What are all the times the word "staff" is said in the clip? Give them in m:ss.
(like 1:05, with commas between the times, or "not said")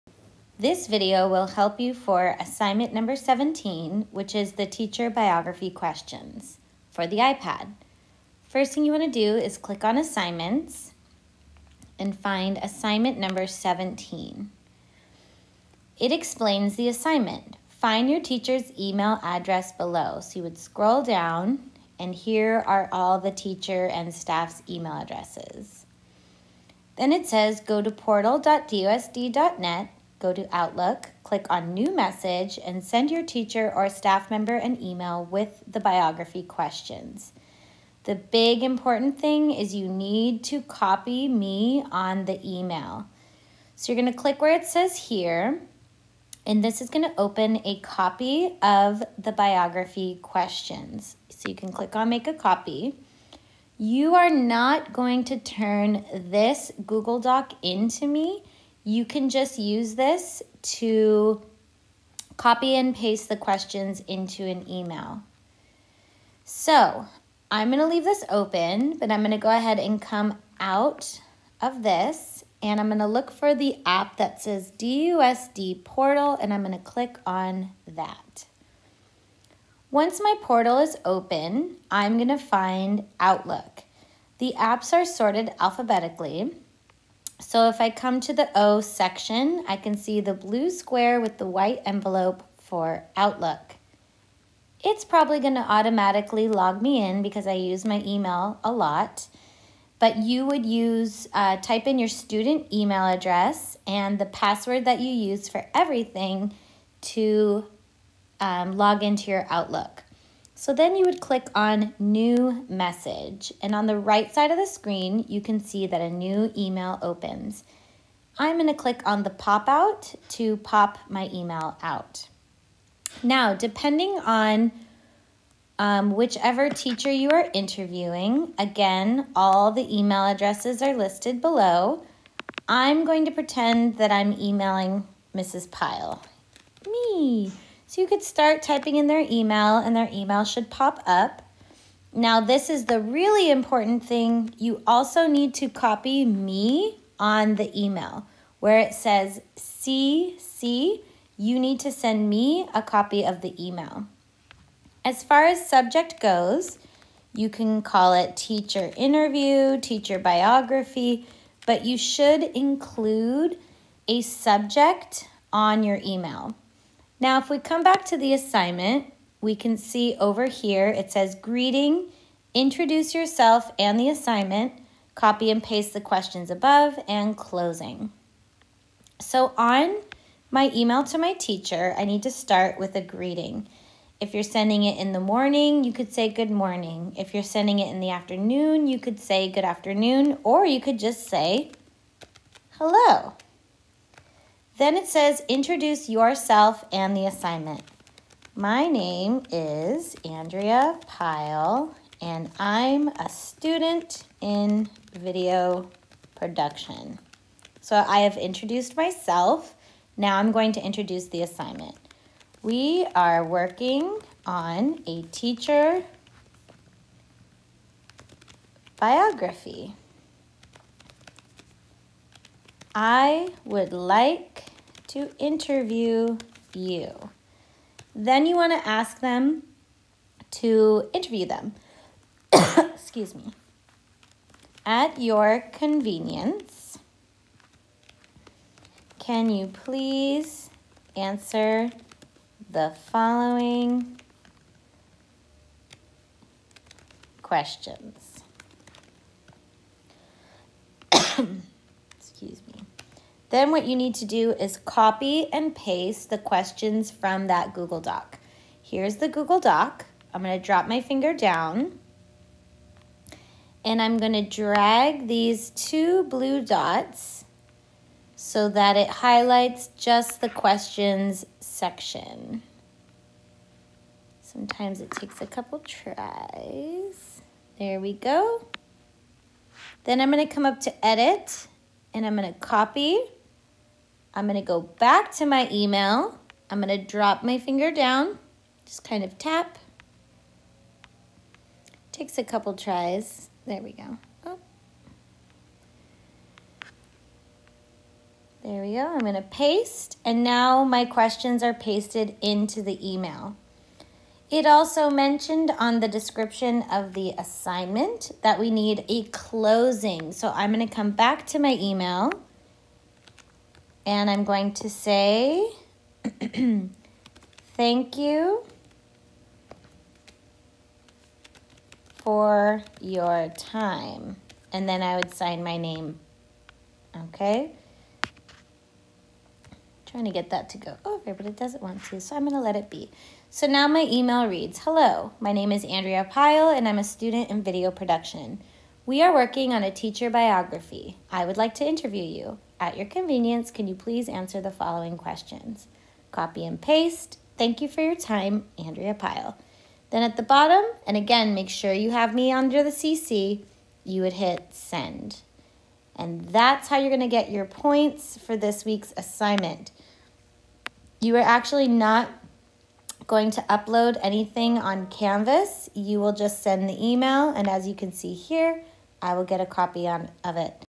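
0:24, 0:33.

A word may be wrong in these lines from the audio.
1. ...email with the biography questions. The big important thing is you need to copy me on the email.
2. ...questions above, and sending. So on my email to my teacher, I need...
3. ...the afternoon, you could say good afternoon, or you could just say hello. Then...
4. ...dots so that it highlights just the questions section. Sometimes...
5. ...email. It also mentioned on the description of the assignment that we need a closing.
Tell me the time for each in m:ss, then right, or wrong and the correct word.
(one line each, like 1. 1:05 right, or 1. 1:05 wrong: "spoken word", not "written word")
1. 0:34 right
2. 2:56 wrong: "closing", not "sending"
3. 3:07 right
4. 4:26 right
5. 5:03 right.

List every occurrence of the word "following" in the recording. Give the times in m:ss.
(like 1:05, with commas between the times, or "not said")
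4:03, 5:44.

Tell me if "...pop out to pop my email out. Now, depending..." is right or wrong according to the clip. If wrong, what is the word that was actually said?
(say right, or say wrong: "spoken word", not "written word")
right.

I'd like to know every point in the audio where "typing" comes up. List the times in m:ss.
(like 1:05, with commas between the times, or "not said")
2:18.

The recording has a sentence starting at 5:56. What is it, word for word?
And that's how you're going to get your points for this week's assignment.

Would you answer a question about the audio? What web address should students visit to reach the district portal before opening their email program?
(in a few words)
portal.dusd.net.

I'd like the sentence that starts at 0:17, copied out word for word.
Find your teacher's email address below.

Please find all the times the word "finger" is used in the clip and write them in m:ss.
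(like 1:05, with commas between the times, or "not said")
4:21, 4:47.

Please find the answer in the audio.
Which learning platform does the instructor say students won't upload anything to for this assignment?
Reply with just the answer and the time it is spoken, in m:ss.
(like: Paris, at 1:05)
Canvas, at 6:05.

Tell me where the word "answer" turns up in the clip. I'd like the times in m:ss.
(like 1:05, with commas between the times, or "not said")
4:01, 5:44.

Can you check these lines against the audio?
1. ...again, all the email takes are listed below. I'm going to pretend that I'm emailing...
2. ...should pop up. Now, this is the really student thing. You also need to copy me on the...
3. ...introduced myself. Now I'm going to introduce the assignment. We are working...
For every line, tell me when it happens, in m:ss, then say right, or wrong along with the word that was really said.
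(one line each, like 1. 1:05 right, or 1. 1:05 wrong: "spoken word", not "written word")
1. 2:08 wrong: "addresses", not "takes"
2. 2:20 wrong: "important", not "student"
3. 3:28 right.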